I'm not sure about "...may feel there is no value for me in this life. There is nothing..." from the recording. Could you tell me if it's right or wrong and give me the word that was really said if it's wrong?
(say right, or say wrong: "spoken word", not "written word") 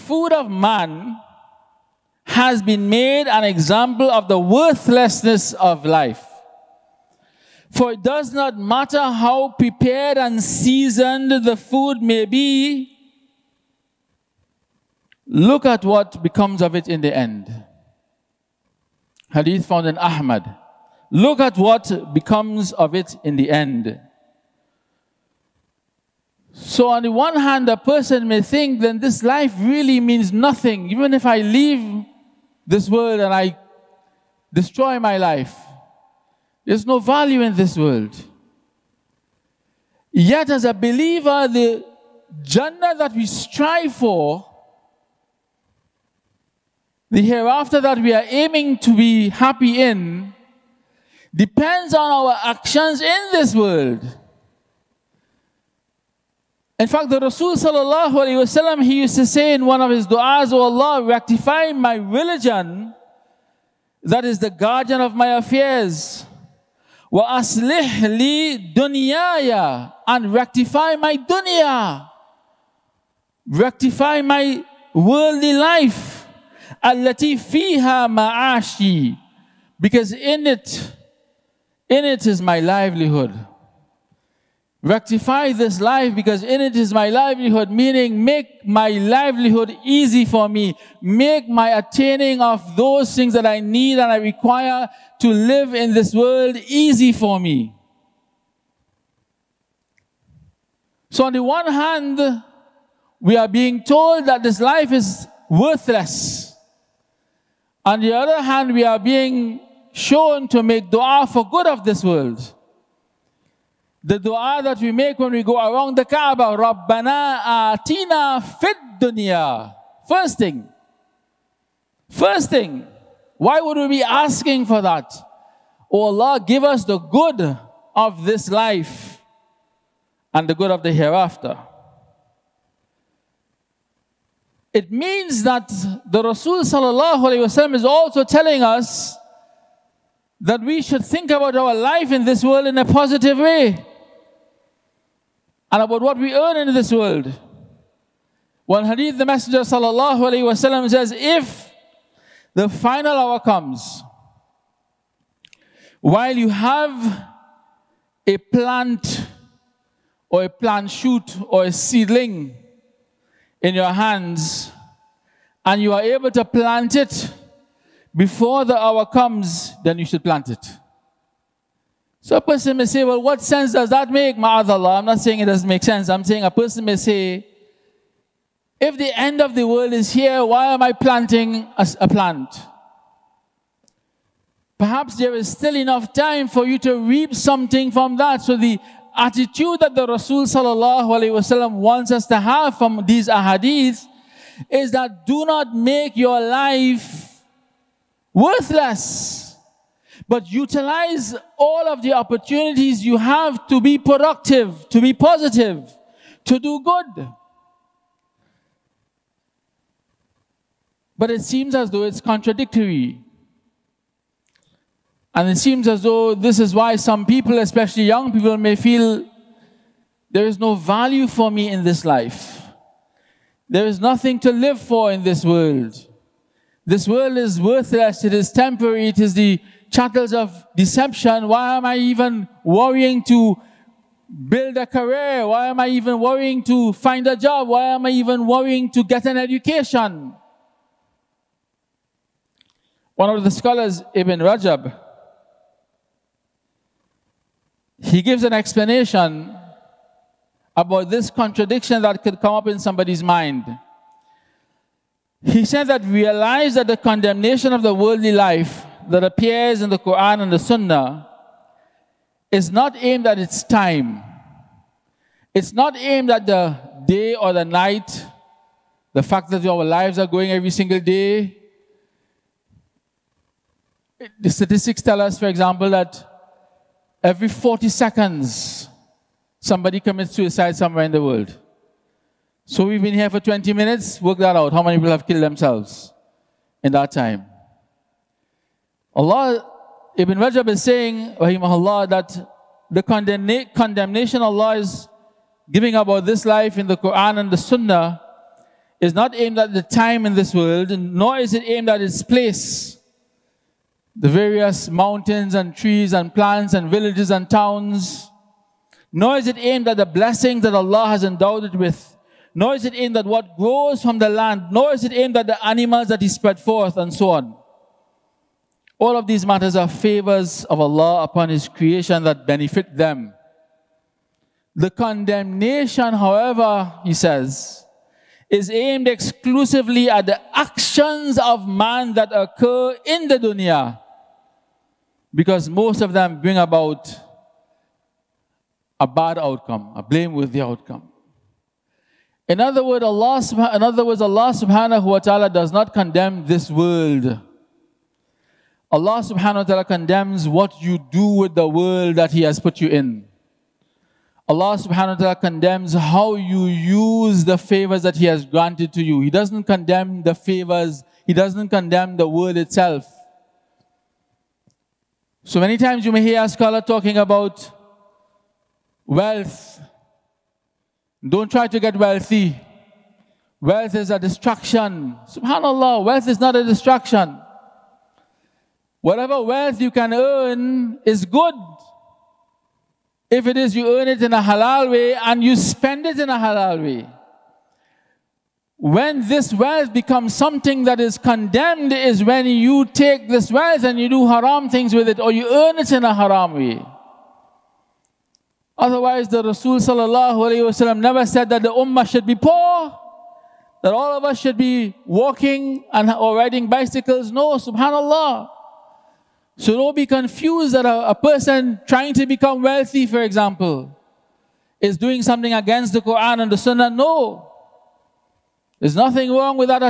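right.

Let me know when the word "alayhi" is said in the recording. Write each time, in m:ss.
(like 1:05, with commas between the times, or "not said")
0:58.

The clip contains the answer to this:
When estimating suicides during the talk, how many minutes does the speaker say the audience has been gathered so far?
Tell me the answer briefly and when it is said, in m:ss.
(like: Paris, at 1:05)
20 minutes, at 4:43.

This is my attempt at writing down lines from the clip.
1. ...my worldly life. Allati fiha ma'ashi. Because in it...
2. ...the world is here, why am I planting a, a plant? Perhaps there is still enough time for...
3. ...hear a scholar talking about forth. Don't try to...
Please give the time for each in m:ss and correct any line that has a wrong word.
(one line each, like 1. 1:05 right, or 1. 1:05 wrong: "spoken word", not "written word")
1. 1:14 right
2. 2:59 right
3. 6:06 wrong: "wealth", not "forth".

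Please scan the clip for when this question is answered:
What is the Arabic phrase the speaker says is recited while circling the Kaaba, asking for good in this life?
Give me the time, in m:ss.
1:56.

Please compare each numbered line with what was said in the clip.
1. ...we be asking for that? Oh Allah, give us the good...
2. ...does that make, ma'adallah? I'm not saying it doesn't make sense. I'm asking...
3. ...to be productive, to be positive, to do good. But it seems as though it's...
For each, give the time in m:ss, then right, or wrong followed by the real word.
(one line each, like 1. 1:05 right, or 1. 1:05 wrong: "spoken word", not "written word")
1. 2:03 right
2. 2:53 wrong: "saying", not "asking"
3. 3:23 right.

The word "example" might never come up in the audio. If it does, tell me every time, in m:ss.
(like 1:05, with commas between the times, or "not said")
0:03, 4:35, 6:53.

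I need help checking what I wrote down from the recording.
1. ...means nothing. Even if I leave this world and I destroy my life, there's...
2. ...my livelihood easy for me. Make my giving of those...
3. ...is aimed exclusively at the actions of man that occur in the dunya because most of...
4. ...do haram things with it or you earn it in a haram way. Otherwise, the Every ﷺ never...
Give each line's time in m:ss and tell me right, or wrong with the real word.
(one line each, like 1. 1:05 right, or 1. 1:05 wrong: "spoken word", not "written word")
1. 0:29 right
2. 1:28 wrong: "attaining", not "giving"
3. 5:28 right
4. 6:34 wrong: "Rasul", not "Every".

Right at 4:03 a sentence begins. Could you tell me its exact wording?
One of the scholars, Ibn Rajab, he gives an explanation about this contradiction that could come up in somebody's mind.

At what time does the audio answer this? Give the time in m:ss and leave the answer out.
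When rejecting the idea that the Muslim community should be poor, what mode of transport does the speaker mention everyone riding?
6:46.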